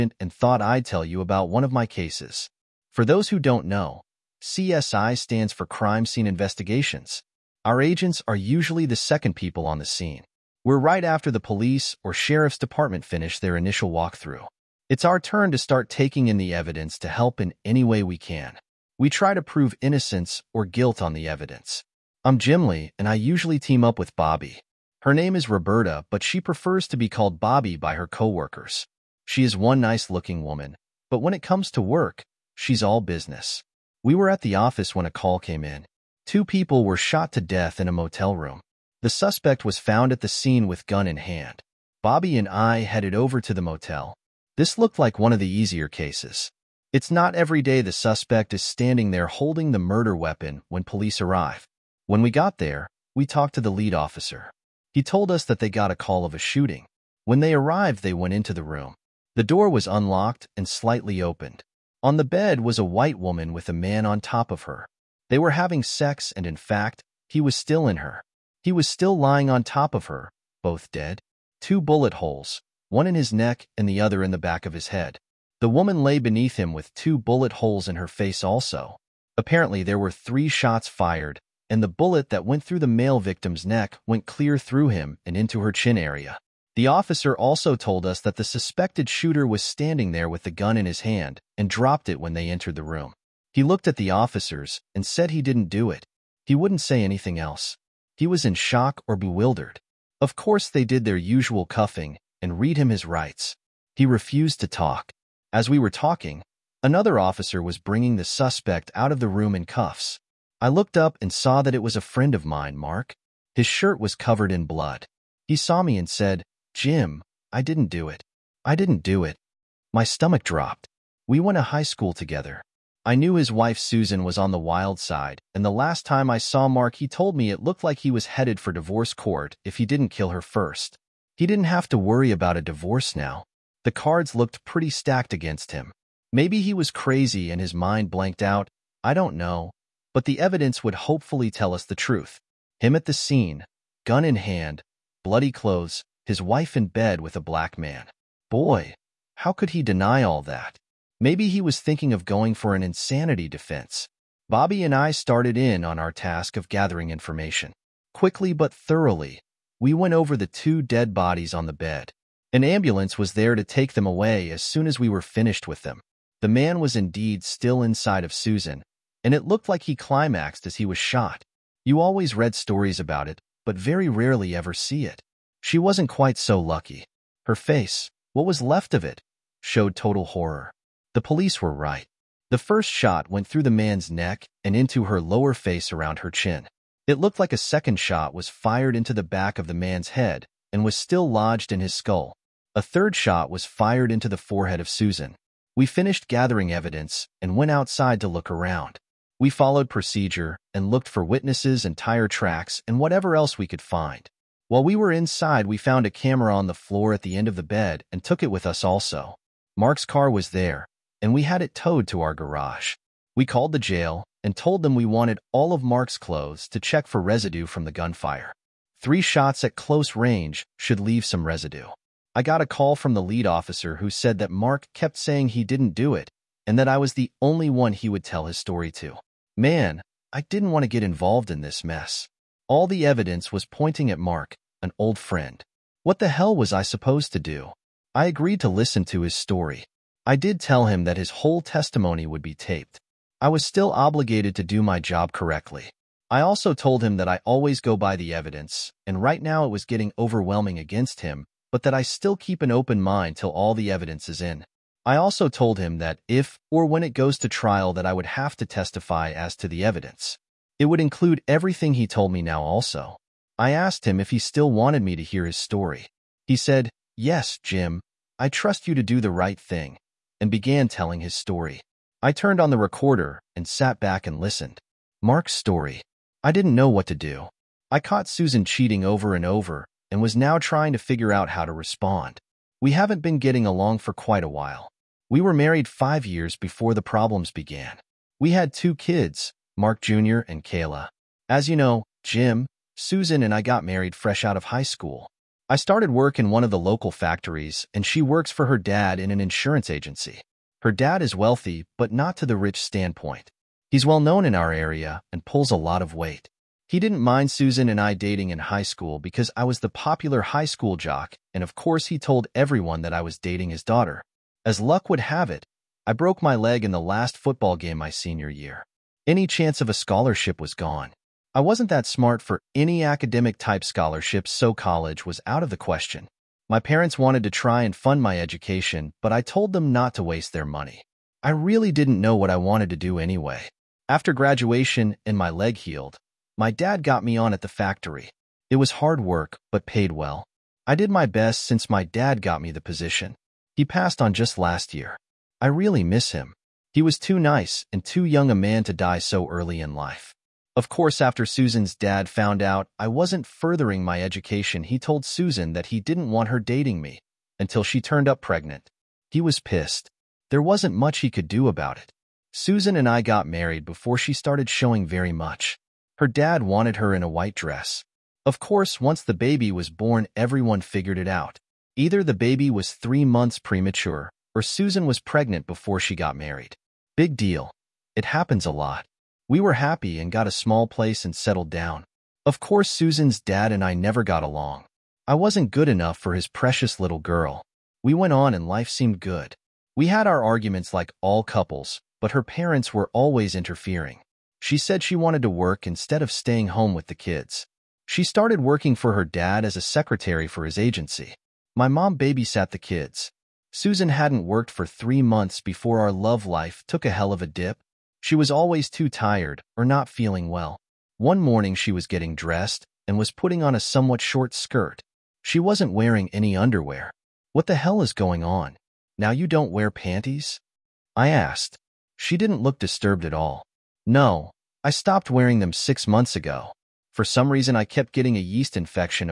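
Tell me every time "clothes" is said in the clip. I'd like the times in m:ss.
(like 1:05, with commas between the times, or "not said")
2:25, 3:36.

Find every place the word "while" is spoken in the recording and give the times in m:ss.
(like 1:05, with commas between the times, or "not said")
3:24, 4:44.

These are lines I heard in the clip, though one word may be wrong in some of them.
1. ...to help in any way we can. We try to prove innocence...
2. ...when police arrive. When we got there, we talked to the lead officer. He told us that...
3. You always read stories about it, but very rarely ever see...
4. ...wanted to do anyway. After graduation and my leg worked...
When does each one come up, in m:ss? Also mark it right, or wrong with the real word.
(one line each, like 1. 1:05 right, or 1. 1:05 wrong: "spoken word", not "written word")
1. 0:16 right
2. 0:50 right
3. 2:51 right
4. 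5:32 wrong: "healed", not "worked".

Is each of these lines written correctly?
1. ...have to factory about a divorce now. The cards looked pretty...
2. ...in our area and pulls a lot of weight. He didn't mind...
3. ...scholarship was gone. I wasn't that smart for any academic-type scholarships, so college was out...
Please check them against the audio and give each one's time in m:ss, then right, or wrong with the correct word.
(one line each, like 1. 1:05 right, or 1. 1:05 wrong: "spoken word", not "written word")
1. 2:11 wrong: "worry", not "factory"
2. 5:04 right
3. 5:19 right.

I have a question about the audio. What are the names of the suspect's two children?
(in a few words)
Mark Jr. and Kayla.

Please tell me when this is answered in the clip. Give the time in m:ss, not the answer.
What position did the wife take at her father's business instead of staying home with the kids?
6:39.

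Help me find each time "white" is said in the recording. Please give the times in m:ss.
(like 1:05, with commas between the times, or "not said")
1:02, 6:07.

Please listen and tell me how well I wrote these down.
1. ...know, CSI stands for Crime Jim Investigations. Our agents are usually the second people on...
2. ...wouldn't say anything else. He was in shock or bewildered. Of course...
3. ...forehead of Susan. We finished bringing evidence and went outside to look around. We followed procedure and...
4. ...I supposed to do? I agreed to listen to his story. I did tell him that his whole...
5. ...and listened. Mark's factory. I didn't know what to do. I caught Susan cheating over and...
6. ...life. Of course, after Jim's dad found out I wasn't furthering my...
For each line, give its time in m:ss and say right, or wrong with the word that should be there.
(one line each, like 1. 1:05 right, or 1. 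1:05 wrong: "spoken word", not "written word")
1. 0:03 wrong: "Scene", not "Jim"
2. 1:36 right
3. 3:14 wrong: "gathering", not "bringing"
4. 3:56 right
5. 4:34 wrong: "story", not "factory"
6. 5:49 wrong: "Susan", not "Jim".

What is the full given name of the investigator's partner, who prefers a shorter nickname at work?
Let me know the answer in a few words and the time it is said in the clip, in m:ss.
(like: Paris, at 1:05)
Roberta, at 0:25.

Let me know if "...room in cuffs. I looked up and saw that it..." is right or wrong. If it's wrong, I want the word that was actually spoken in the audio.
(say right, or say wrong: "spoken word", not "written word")
right.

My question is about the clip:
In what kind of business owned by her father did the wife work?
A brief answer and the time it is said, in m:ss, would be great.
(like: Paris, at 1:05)
Insurance agency, at 4:59.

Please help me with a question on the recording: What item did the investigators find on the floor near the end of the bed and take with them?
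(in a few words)
A camera.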